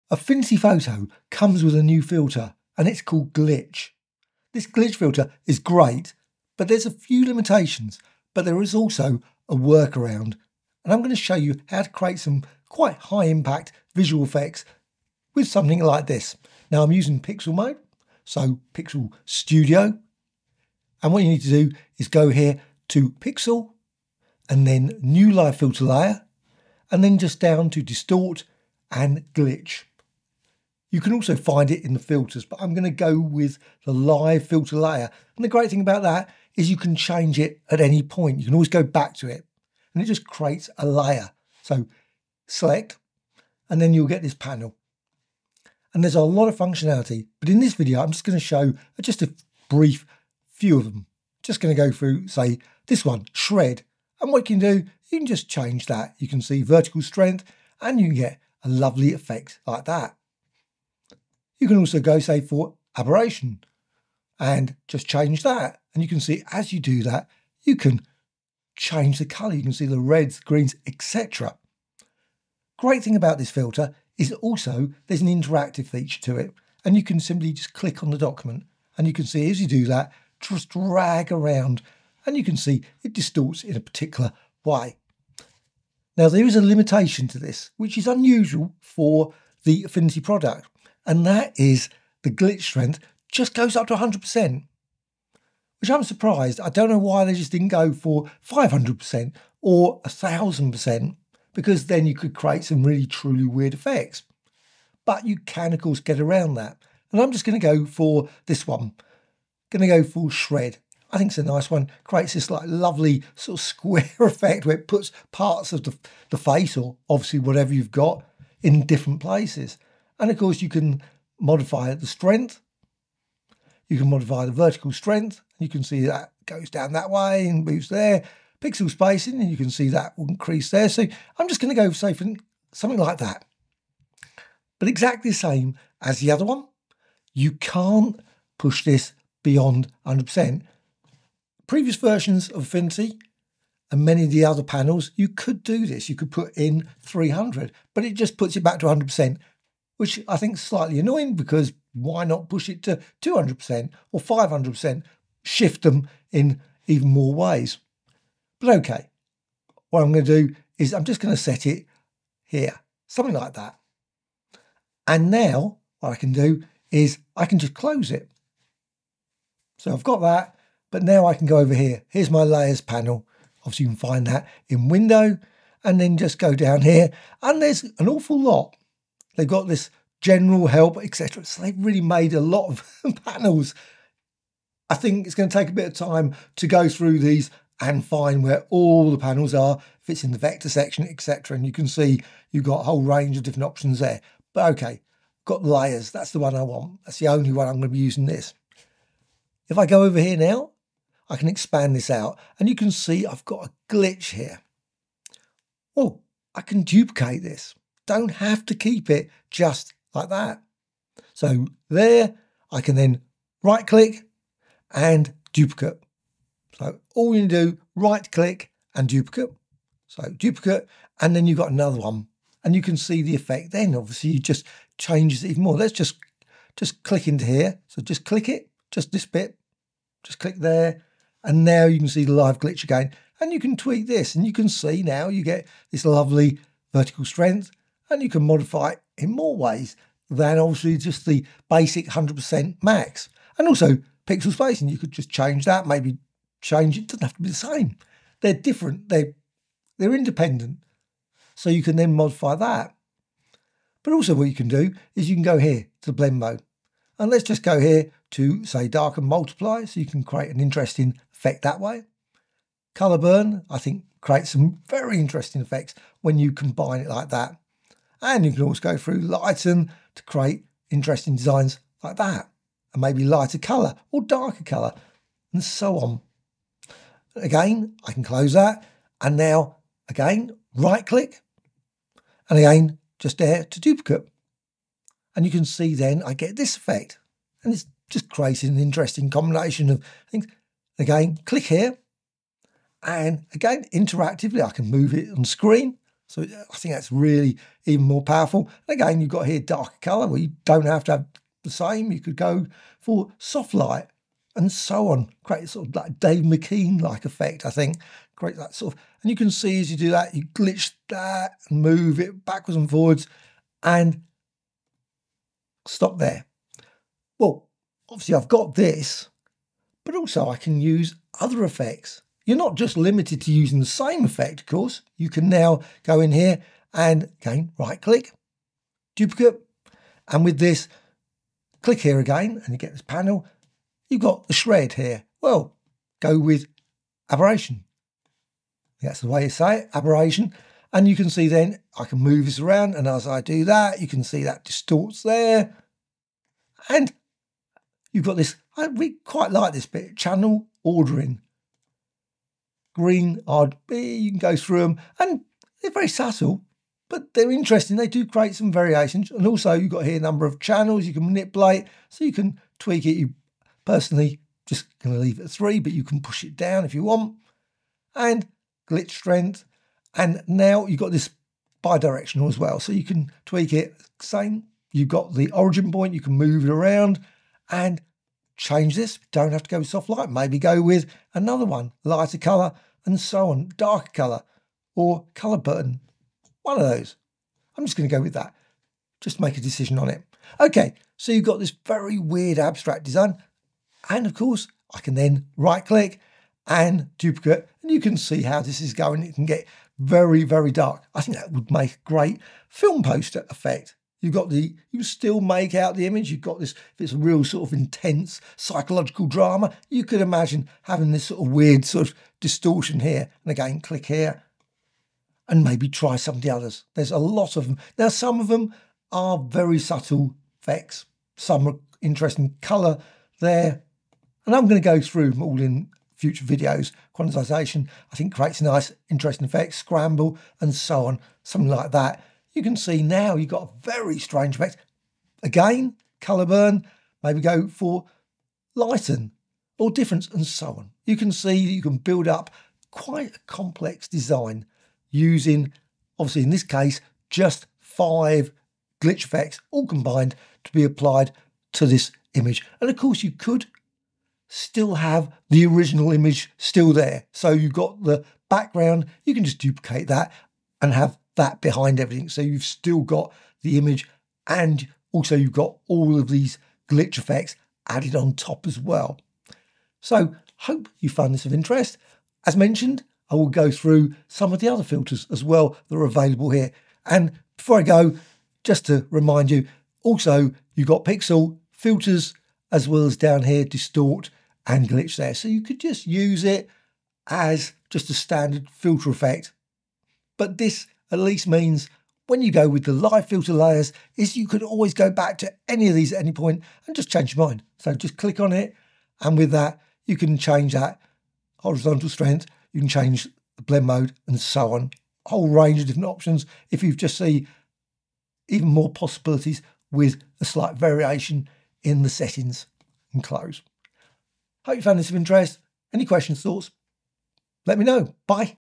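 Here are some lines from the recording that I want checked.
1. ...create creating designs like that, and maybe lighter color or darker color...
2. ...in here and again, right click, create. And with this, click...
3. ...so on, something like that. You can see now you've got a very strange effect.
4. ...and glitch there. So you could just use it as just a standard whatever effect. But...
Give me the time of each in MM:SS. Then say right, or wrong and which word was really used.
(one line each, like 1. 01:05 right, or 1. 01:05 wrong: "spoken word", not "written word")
1. 04:30 wrong: "interesting", not "creating"
2. 05:26 wrong: "duplicate", not "create"
3. 07:10 right
4. 08:04 wrong: "filter", not "whatever".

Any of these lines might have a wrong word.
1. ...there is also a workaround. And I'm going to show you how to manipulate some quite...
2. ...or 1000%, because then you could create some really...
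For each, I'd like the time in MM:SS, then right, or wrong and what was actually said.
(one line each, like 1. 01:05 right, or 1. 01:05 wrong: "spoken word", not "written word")
1. 00:08 wrong: "create", not "manipulate"
2. 01:39 right.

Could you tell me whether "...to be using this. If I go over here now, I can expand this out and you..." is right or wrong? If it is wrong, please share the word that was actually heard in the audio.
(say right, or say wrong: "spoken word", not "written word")
right.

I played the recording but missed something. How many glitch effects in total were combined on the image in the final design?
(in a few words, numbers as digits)
5.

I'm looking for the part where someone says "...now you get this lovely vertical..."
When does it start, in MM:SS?
03:55.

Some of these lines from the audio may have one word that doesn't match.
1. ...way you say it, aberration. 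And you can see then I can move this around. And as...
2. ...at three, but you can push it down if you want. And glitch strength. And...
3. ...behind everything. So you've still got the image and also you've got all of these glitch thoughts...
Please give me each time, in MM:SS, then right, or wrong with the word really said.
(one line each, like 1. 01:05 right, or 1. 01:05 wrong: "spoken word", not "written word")
1. 05:39 right
2. 06:05 right
3. 07:41 wrong: "effects", not "thoughts".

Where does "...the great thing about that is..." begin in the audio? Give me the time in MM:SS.
00:35.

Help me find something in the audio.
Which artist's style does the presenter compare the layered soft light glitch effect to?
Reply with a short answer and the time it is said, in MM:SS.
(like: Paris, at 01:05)
Dave McKean, at 05:06.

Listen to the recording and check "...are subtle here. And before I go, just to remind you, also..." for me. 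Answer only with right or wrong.
wrong.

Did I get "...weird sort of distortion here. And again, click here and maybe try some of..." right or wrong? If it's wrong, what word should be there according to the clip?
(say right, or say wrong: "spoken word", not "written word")
right.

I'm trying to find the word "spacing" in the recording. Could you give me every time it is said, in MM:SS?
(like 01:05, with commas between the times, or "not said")
02:08, 04:04.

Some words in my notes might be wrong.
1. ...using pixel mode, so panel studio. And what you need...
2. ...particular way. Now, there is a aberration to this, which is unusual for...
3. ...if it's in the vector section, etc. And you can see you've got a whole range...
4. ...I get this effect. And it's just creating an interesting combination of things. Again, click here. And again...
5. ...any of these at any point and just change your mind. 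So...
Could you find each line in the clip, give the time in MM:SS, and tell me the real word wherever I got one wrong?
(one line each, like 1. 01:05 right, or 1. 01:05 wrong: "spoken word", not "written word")
1. 00:16 wrong: "pixel", not "panel"
2. 01:23 wrong: "limitation", not "aberration"
3. 03:10 right
4. 04:46 right
5. 08:15 right.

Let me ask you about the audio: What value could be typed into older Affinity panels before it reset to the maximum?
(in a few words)
300.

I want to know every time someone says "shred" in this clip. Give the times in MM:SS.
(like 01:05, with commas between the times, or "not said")
00:53, 01:50, 05:34.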